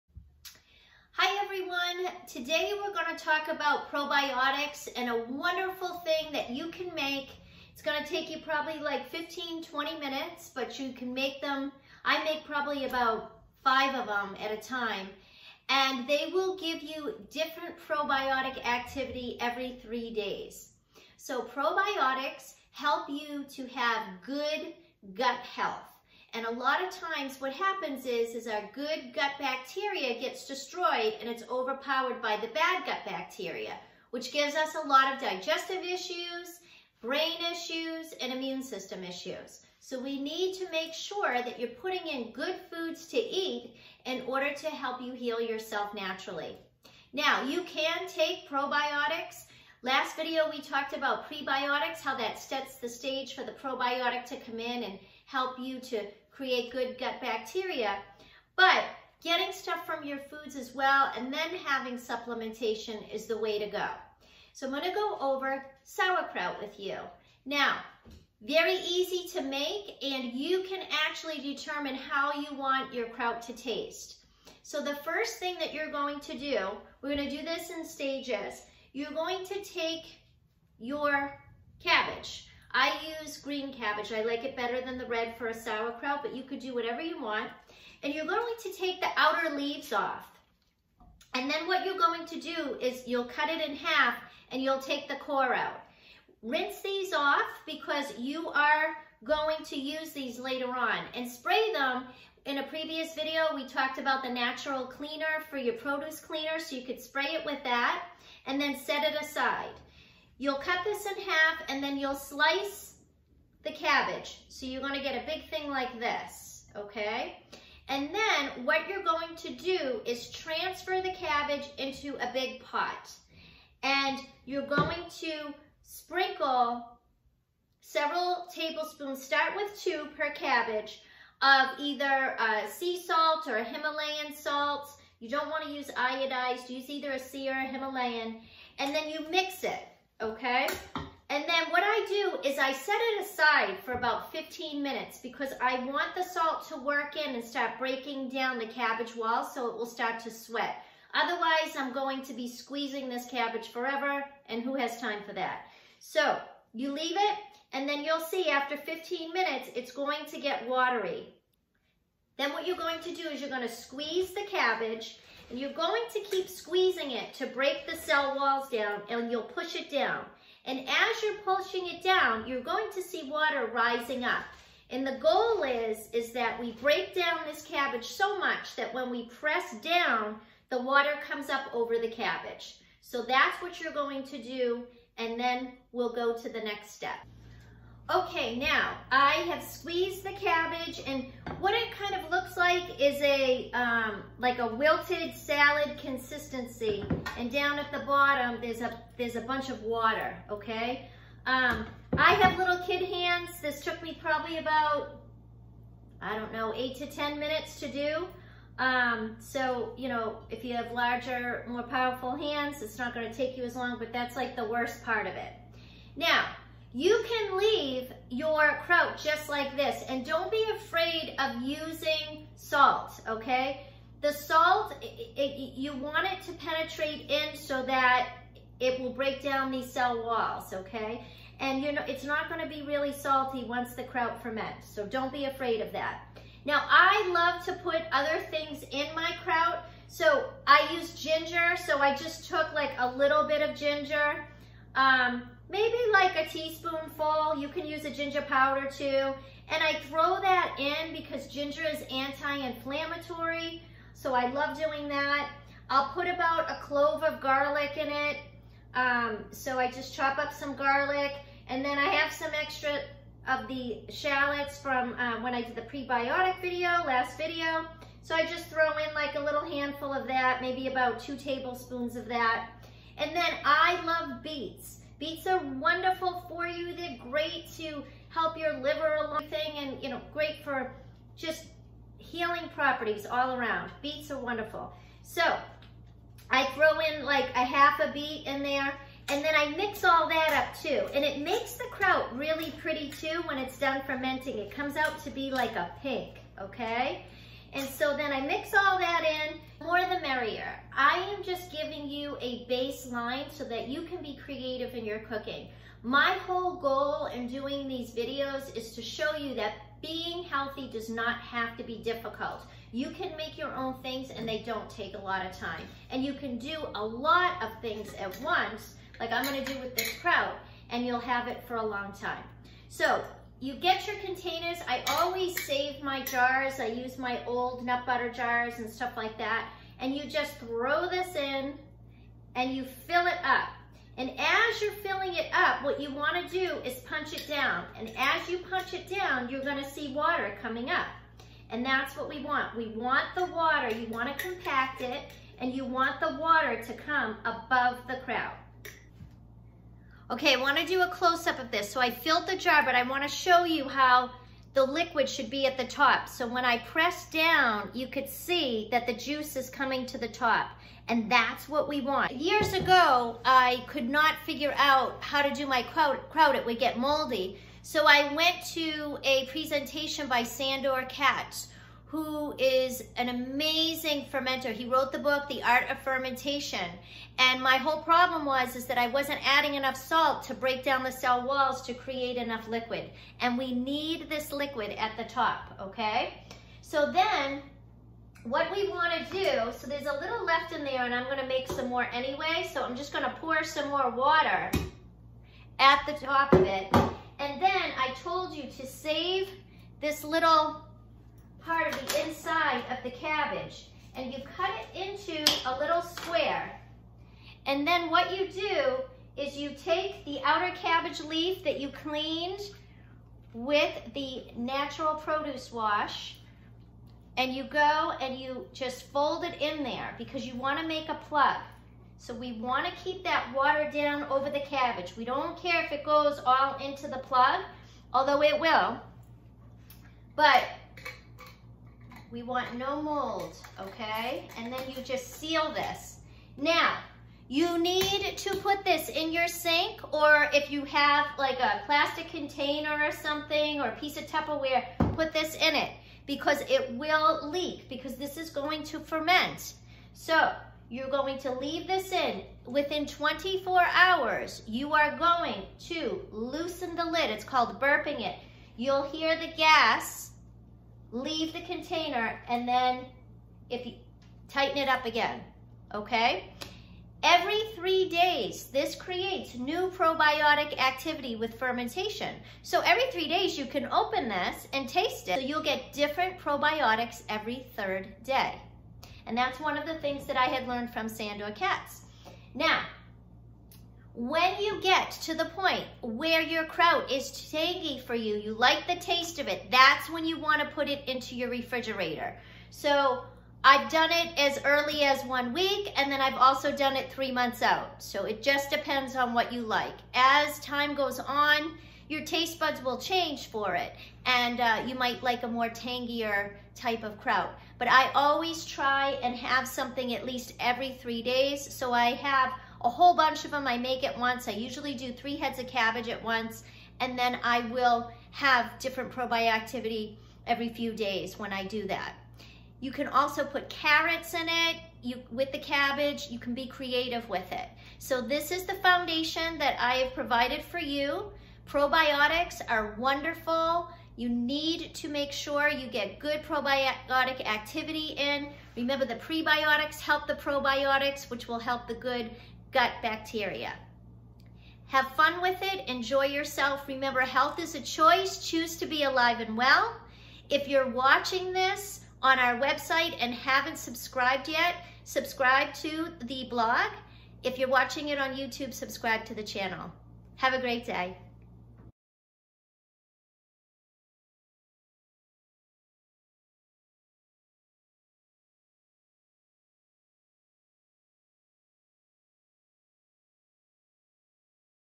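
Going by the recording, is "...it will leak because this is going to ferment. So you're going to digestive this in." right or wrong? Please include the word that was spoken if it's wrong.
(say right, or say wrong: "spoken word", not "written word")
wrong: "leave", not "digestive".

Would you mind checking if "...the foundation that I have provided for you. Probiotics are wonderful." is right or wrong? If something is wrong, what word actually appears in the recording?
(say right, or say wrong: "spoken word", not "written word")
right.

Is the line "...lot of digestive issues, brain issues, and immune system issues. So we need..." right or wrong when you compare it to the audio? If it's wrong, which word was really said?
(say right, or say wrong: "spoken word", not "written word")
right.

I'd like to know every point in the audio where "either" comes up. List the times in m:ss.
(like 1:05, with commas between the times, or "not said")
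2:11, 2:16.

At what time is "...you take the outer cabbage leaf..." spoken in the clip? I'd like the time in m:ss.
6:49.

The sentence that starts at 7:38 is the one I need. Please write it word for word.
You'll hear the gas leave the container, and then if you tighten it up again, okay?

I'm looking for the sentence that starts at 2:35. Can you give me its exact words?
So you leave it, and then you'll see after 15 minutes, it's going to get watery.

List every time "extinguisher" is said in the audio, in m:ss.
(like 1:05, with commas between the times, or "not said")
not said.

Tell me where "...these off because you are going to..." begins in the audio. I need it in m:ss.
1:36.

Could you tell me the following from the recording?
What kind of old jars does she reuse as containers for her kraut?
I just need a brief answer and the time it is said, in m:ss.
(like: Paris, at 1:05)
Nut butter jars, at 5:27.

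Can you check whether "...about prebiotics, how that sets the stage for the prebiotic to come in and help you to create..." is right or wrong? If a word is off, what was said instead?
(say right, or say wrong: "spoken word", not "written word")
wrong: "probiotic", not "prebiotic".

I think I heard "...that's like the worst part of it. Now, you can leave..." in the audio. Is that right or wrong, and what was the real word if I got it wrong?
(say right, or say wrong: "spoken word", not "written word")
right.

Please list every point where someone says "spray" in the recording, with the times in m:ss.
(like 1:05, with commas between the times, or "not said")
1:41, 1:46.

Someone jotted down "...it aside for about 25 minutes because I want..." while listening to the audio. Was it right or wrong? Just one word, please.
wrong.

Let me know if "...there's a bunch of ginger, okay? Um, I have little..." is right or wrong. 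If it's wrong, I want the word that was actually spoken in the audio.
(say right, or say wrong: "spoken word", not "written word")
wrong: "water", not "ginger".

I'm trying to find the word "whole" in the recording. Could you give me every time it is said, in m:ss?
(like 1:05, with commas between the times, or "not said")
5:06, 6:17, 8:32.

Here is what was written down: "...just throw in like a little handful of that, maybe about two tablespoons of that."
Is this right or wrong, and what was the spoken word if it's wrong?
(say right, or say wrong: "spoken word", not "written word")
right.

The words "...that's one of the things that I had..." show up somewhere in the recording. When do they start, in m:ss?
7:59.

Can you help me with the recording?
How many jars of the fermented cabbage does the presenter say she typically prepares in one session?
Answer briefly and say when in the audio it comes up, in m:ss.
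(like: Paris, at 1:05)
5, at 0:13.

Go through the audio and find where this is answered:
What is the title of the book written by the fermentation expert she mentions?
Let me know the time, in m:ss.
6:15.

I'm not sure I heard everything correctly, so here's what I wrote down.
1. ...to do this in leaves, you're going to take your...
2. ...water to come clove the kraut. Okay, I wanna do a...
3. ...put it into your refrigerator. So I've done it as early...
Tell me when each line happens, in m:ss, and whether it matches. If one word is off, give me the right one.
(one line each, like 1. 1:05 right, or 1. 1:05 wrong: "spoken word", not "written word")
1. 1:17 wrong: "stages", not "leaves"
2. 5:46 wrong: "above", not "clove"
3. 8:10 right.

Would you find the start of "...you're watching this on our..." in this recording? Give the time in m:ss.
9:10.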